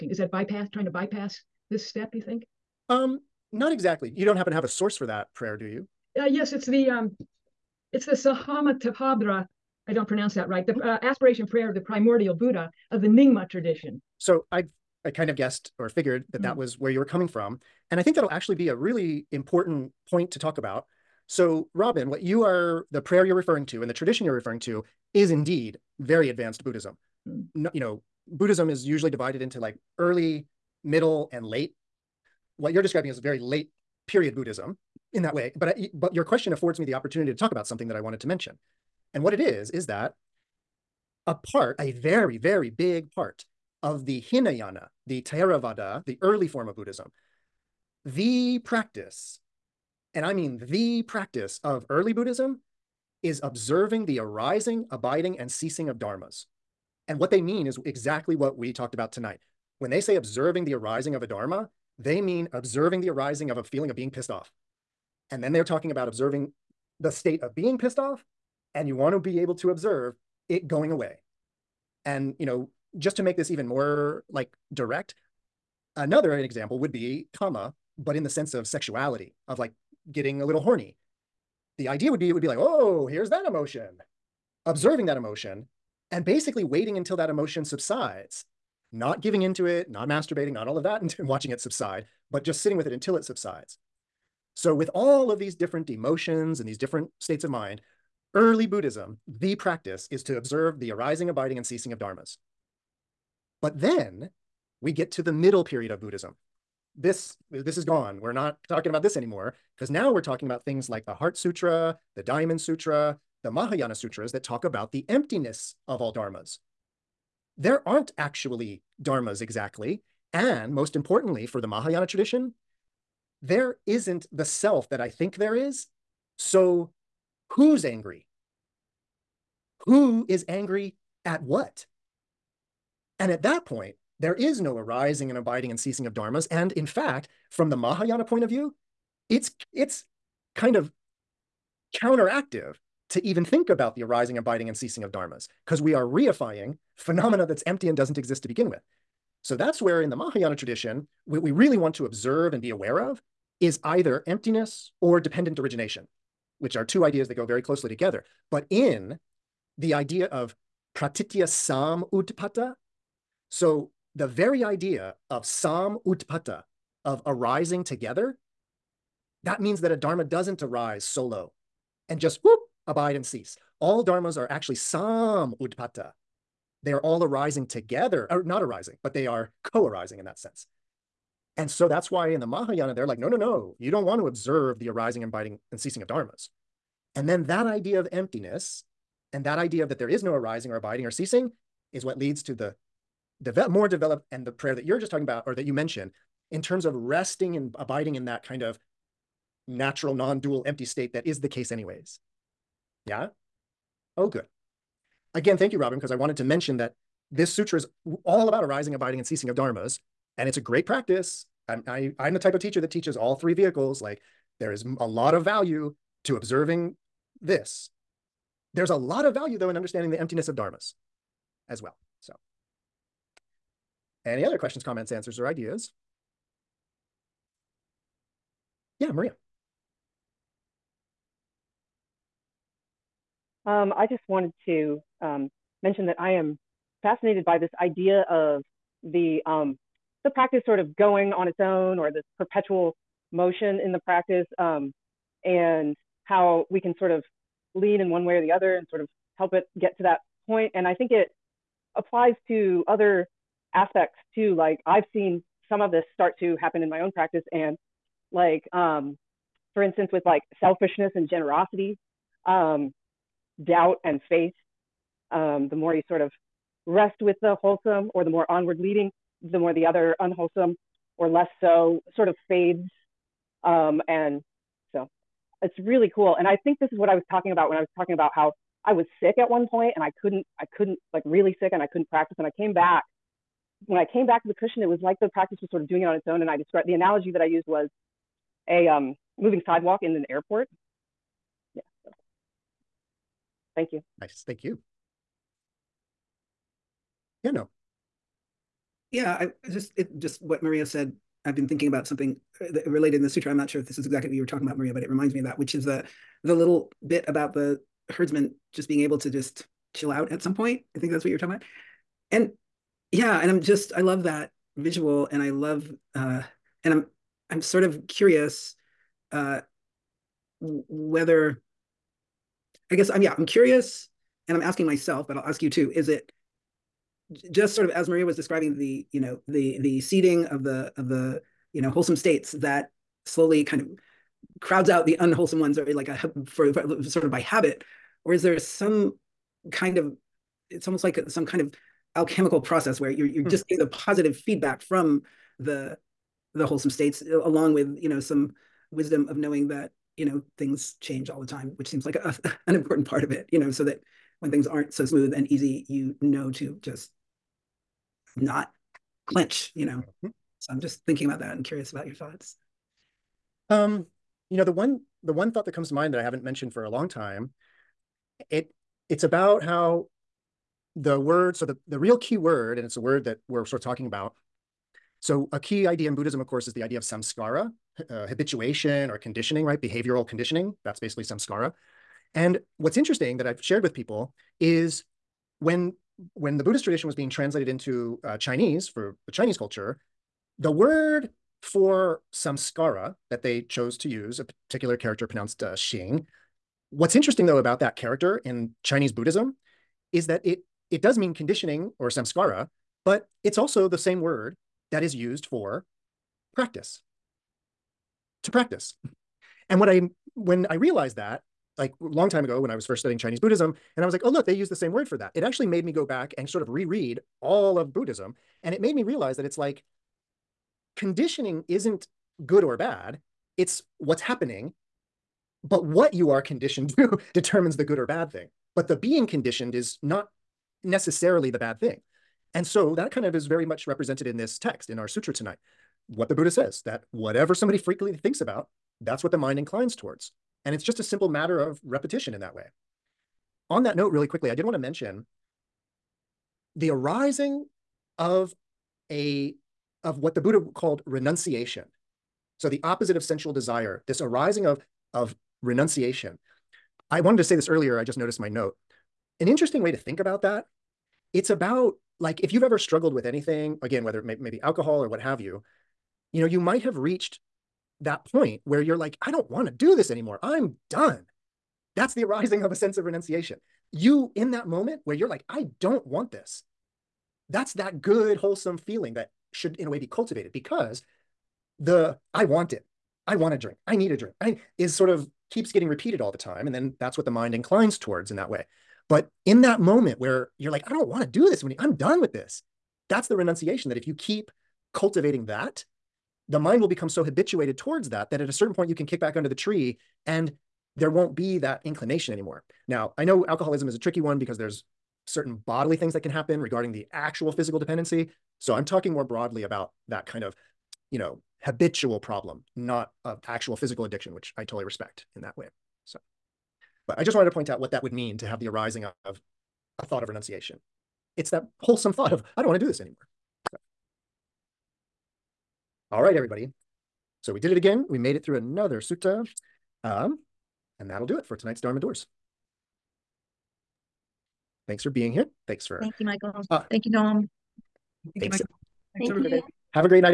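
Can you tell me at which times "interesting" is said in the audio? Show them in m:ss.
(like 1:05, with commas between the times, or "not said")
6:22, 6:37, 7:39.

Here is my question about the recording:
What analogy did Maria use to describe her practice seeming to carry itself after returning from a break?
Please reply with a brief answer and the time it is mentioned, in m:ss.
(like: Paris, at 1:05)
Moving sidewalk, at 4:49.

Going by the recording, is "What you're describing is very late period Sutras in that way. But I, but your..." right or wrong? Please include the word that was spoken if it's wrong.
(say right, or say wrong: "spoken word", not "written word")
wrong: "Buddhism", not "Sutras".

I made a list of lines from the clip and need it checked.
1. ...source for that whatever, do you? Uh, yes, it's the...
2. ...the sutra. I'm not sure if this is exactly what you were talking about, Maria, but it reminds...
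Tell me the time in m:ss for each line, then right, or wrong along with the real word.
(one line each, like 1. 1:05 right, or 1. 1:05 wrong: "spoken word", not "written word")
1. 0:04 wrong: "prayer", not "whatever"
2. 5:03 right.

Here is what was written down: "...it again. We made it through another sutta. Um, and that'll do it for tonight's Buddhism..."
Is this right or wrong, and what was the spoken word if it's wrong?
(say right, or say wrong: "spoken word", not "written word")
wrong: "Dharma", not "Buddhism".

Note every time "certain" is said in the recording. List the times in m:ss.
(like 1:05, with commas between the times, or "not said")
8:18, 8:25.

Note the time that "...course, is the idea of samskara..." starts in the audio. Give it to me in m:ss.
6:16.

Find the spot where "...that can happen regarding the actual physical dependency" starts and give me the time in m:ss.
8:26.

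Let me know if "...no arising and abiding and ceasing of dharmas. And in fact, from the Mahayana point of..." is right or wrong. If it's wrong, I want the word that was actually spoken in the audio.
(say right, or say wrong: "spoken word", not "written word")
right.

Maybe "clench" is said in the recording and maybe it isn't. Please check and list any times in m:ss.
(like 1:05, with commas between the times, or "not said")
5:59.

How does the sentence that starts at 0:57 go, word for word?
And what they mean is exactly what we talked about tonight.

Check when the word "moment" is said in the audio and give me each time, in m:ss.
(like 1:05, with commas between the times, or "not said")
7:54, 8:09.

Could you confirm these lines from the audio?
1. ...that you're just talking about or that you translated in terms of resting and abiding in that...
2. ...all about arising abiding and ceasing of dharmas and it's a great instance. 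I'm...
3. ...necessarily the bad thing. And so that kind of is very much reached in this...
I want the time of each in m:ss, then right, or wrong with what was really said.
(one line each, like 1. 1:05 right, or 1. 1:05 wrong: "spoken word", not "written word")
1. 3:14 wrong: "mentioned", not "translated"
2. 3:28 wrong: "practice", not "instance"
3. 7:10 wrong: "represented", not "reached".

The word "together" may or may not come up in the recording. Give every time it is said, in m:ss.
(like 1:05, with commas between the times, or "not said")
2:37, 2:47, 2:57.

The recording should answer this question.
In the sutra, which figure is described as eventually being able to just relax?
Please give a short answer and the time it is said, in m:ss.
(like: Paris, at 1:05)
The herdsman, at 5:08.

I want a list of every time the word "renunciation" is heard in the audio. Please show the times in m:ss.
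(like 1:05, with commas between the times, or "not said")
7:31, 7:35, 7:53, 8:13, 8:40.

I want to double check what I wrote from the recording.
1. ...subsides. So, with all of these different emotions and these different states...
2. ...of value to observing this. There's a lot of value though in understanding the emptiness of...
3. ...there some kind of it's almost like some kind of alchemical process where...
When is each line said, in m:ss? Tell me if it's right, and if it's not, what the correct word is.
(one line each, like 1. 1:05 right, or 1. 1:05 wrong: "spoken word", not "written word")
1. 1:33 right
2. 3:35 right
3. 5:38 right.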